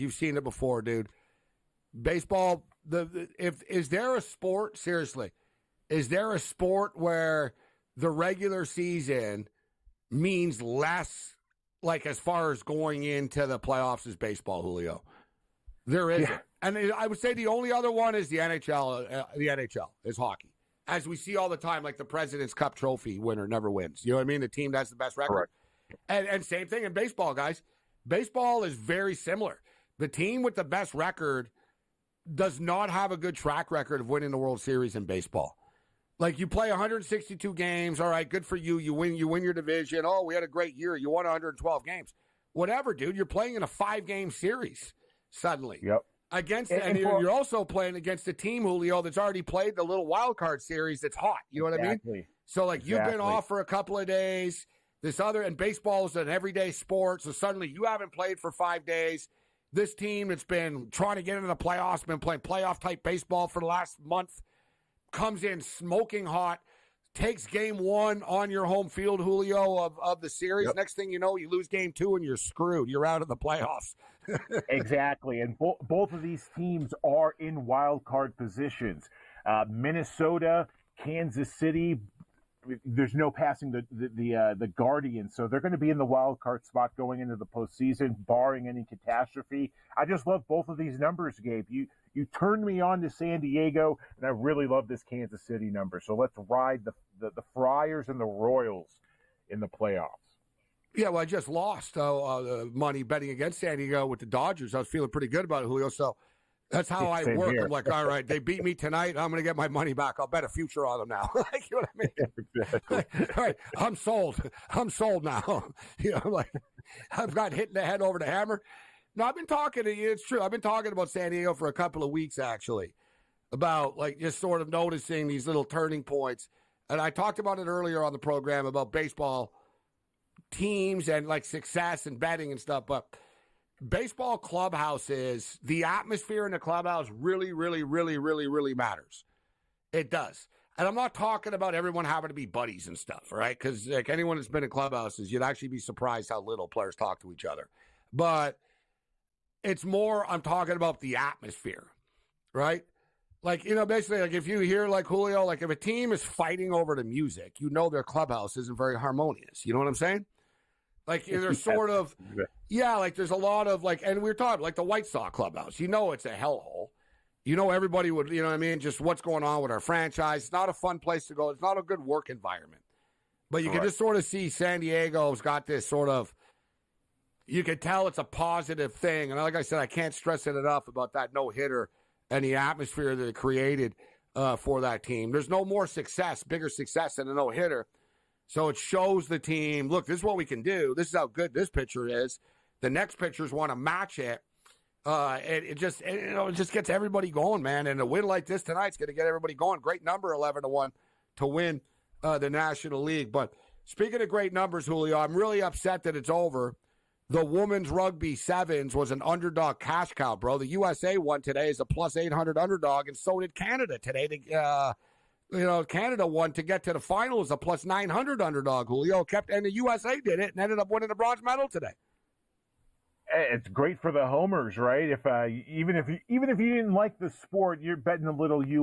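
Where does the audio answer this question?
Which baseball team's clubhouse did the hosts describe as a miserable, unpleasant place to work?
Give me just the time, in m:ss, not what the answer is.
2:44.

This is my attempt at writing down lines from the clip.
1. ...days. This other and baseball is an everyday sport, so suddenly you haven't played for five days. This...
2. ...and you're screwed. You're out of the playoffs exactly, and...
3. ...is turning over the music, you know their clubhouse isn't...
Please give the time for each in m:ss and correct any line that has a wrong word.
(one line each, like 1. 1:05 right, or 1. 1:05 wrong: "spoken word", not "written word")
1. 0:54 right
2. 1:12 right
3. 2:36 wrong: "fighting", not "turning".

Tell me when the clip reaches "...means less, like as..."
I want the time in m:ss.
0:10.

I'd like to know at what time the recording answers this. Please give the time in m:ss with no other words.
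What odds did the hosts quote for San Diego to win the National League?
3:20.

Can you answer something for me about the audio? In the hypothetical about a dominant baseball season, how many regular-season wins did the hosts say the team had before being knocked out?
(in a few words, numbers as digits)
112.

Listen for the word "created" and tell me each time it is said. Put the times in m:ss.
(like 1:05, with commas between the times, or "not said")
3:03.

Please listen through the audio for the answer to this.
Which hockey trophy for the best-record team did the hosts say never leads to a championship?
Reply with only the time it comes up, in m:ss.
0:22.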